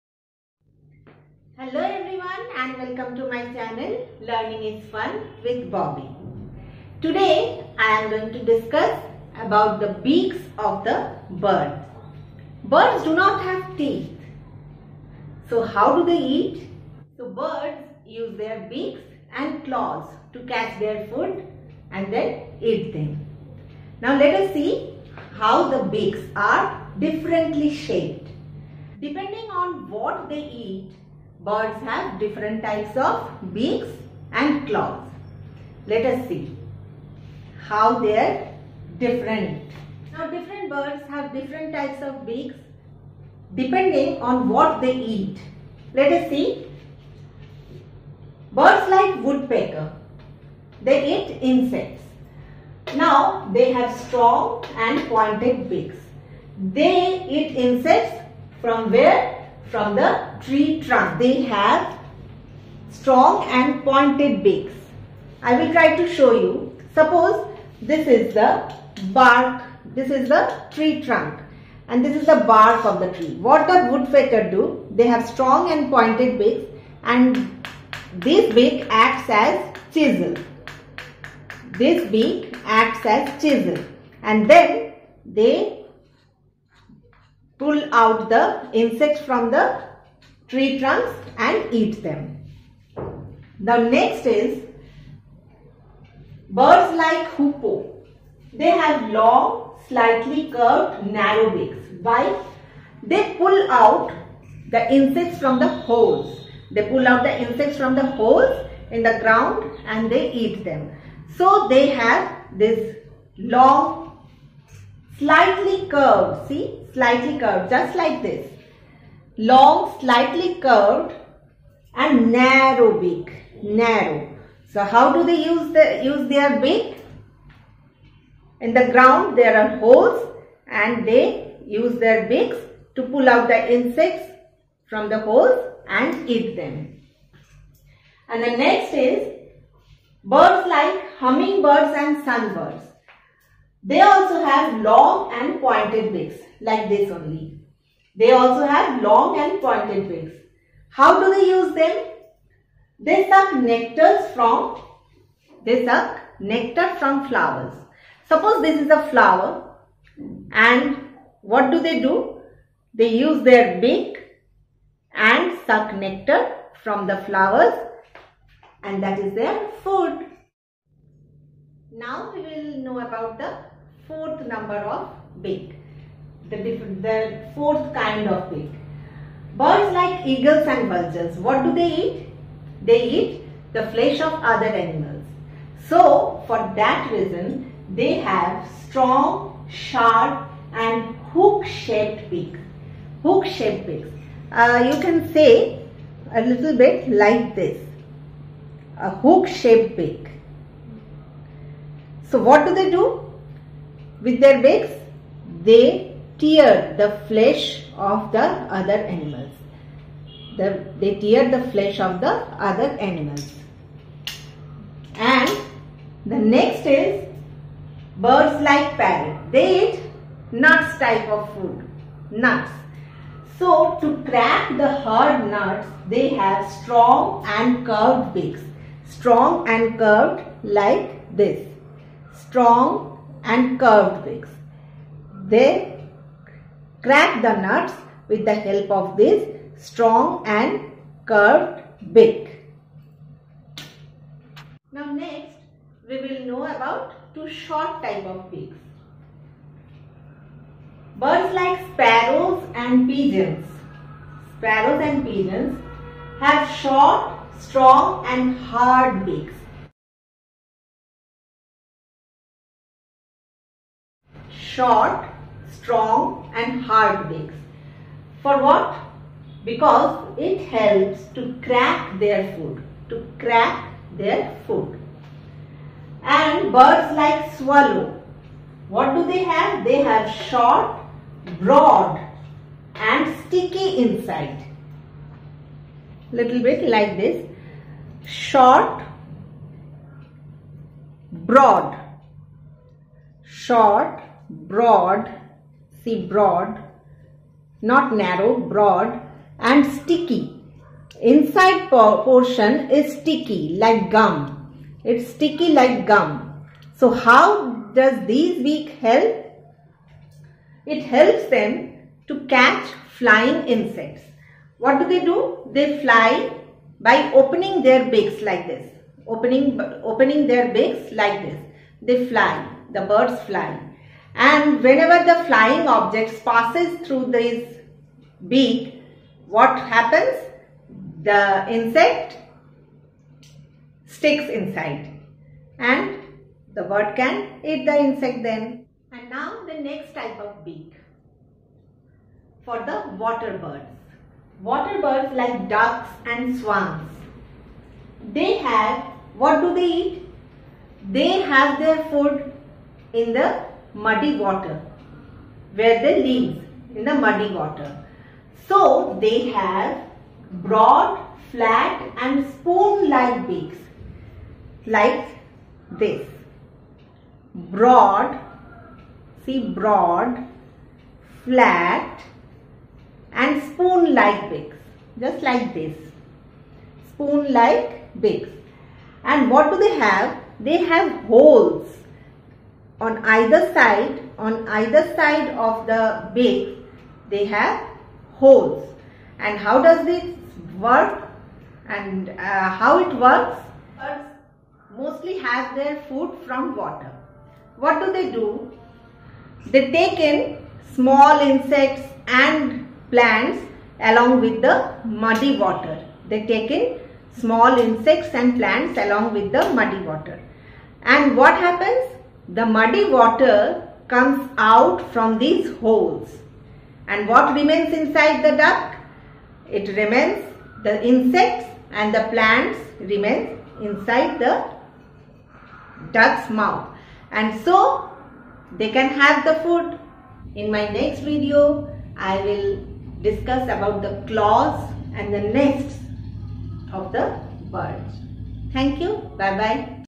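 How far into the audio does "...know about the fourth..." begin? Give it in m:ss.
2:52.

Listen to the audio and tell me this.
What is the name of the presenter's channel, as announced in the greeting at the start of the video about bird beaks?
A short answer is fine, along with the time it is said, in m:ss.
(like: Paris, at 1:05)
Learning is Fun with Bobby, at 0:04.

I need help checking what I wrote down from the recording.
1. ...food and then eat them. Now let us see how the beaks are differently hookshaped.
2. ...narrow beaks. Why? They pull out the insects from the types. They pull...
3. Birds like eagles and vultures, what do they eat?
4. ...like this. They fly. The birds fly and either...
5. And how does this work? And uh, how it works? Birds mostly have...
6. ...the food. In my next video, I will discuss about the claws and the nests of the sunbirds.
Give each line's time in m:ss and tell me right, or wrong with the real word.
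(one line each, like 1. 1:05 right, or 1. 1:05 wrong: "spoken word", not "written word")
1. 0:21 wrong: "shaped", not "hookshaped"
2. 1:41 wrong: "holes", not "types"
3. 2:59 right
4. 5:21 wrong: "whenever", not "either"
5. 6:29 right
6. 7:09 wrong: "birds", not "sunbirds".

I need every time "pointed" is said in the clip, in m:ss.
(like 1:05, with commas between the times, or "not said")
0:55, 1:03, 1:15, 2:25, 2:29.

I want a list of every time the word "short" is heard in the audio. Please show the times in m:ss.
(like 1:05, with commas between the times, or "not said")
4:07, 4:16, 4:24, 4:40, 4:48, 4:53.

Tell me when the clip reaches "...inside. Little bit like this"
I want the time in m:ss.
4:44.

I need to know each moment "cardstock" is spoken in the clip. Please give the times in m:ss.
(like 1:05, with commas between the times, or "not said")
not said.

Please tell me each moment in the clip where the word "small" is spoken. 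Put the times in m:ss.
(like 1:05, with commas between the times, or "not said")
6:40, 6:47.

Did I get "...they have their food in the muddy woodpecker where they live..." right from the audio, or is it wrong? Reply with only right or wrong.
wrong.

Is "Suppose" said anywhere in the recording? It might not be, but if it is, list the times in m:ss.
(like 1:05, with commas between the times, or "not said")
1:06, 2:38.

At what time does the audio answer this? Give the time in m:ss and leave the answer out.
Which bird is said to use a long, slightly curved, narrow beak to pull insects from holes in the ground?
1:37.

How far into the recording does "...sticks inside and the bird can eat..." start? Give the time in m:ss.
5:34.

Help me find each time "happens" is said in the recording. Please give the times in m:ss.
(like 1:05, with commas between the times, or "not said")
5:29, 6:51.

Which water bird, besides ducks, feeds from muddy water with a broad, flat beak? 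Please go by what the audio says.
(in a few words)
Swans.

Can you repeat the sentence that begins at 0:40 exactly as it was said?
Now different birds have different types of beaks depending on what they eat.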